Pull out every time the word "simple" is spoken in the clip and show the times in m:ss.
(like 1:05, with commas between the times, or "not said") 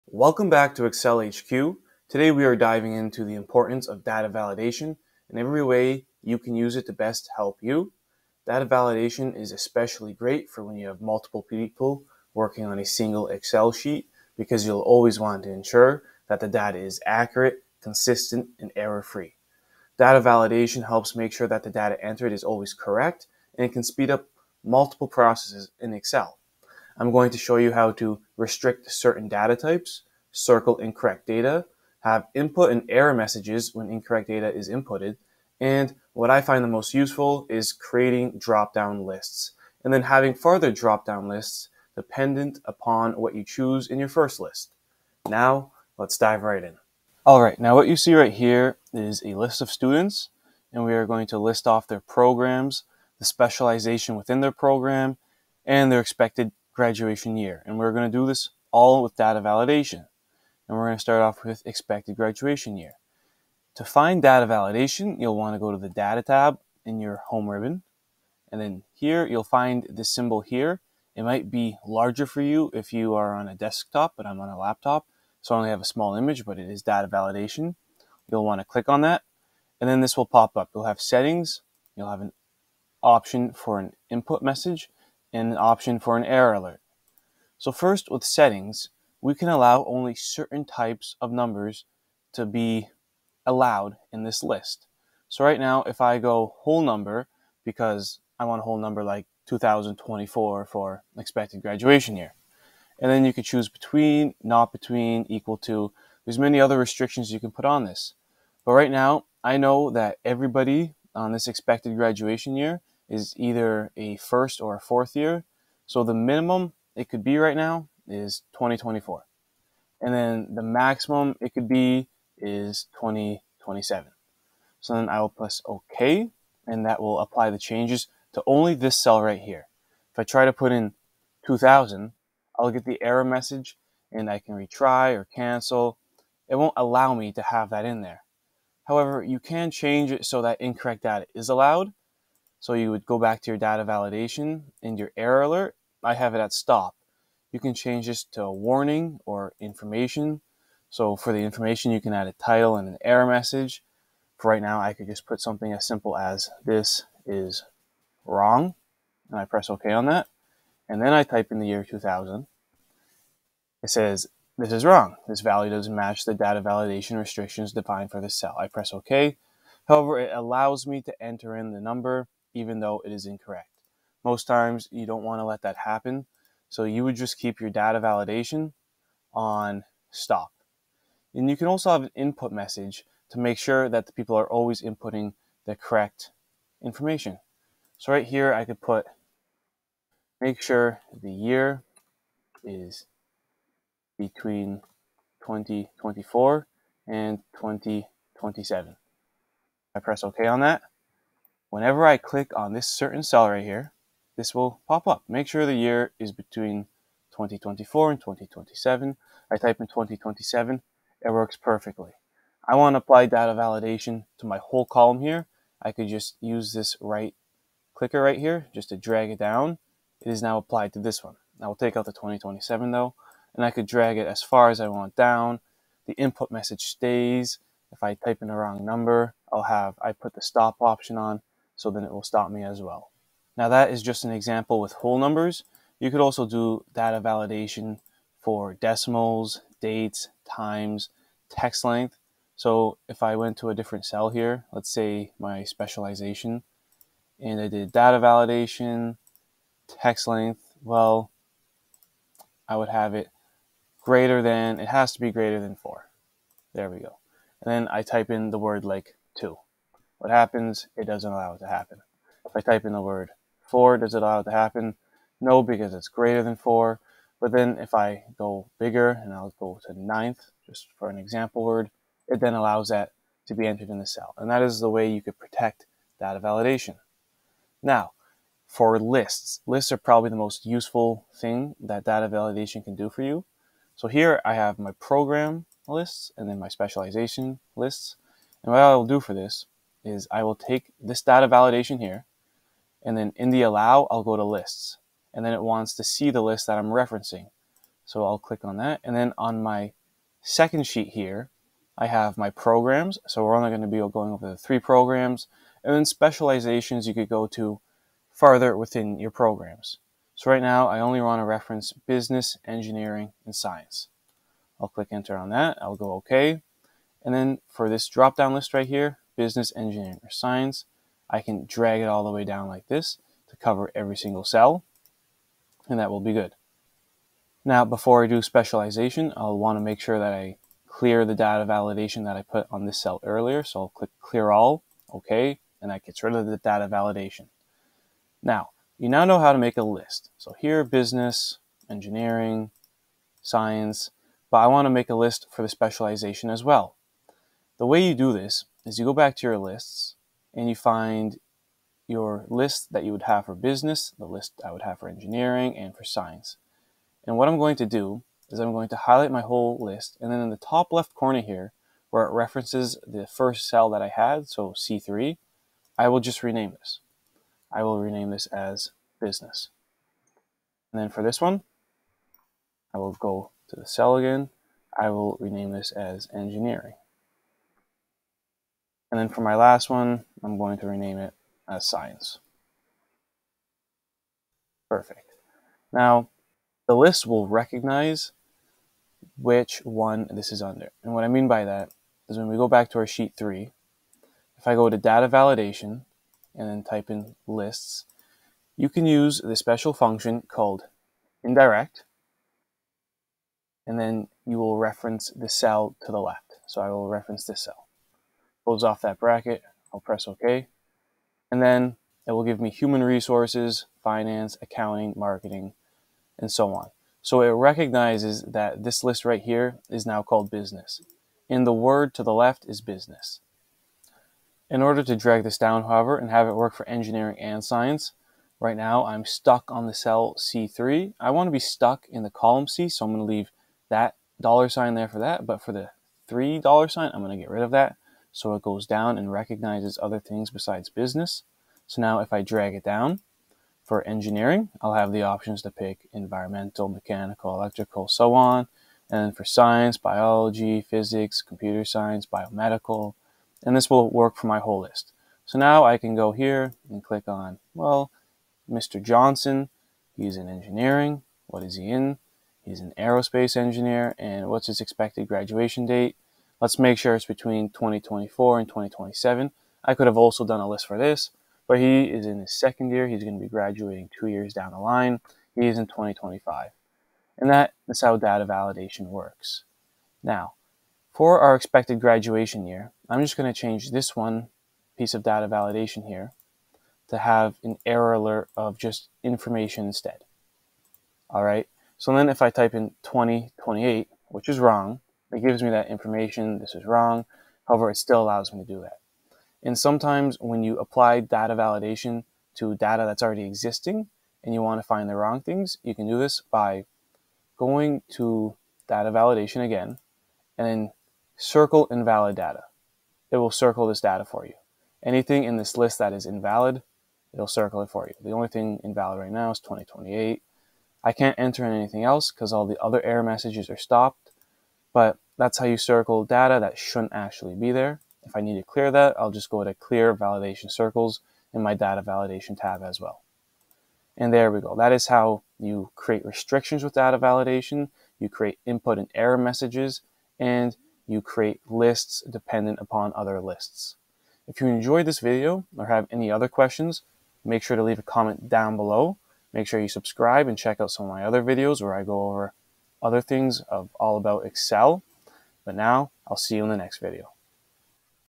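2:35.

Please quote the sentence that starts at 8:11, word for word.
So then if I type in 2028, which is wrong, it gives me that information, this is wrong.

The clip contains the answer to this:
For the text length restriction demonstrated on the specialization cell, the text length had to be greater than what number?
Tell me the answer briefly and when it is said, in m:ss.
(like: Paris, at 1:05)
4, at 4:15.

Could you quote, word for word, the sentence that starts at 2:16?
It won't allow me to have that in there.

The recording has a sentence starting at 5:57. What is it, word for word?
And what I'm going to do is I'm going to highlight my whole list.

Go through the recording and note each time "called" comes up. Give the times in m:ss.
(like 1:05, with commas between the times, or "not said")
6:40, 7:00.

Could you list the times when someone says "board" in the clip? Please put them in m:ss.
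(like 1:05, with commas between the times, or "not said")
not said.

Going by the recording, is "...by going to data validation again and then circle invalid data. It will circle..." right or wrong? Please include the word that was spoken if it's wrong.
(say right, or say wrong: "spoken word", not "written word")
right.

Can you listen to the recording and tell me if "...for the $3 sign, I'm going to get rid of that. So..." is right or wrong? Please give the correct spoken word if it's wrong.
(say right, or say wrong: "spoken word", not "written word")
right.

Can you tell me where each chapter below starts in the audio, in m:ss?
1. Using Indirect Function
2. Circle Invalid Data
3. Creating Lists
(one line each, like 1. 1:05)
1. 5:40
2. 8:05
3. 4:38.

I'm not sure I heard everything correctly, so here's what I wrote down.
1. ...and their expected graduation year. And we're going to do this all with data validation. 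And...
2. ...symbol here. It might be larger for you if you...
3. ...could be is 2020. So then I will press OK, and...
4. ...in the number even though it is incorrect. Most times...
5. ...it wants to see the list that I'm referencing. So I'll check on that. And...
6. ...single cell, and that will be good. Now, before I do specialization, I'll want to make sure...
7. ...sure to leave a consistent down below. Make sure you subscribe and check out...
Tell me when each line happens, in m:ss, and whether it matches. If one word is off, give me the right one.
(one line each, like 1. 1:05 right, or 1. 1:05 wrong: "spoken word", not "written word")
1. 0:55 right
2. 1:10 right
3. 2:01 wrong: "2027", not "2020"
4. 2:51 right
5. 4:55 wrong: "click", not "check"
6. 5:24 right
7. 9:07 wrong: "comment", not "consistent".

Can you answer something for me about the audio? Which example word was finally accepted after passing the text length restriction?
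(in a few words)
ninth.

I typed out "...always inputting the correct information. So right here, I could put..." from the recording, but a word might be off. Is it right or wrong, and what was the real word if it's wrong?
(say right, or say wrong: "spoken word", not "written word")
right.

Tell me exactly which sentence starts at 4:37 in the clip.
Now, for lists, lists are probably the most useful thing that data validation can do for you.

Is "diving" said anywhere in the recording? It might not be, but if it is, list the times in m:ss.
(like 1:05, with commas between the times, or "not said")
0:02.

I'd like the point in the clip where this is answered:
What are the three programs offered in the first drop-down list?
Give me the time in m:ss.
5:11.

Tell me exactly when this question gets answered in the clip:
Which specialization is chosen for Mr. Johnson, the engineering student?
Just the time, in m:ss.
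7:42.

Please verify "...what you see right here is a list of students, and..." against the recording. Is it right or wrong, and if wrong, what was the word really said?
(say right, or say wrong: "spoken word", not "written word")
right.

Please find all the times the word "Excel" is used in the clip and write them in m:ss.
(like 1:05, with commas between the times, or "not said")
0:00, 0:13, 0:25, 9:14.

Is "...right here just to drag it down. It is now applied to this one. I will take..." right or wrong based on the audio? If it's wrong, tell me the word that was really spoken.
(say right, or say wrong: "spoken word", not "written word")
right.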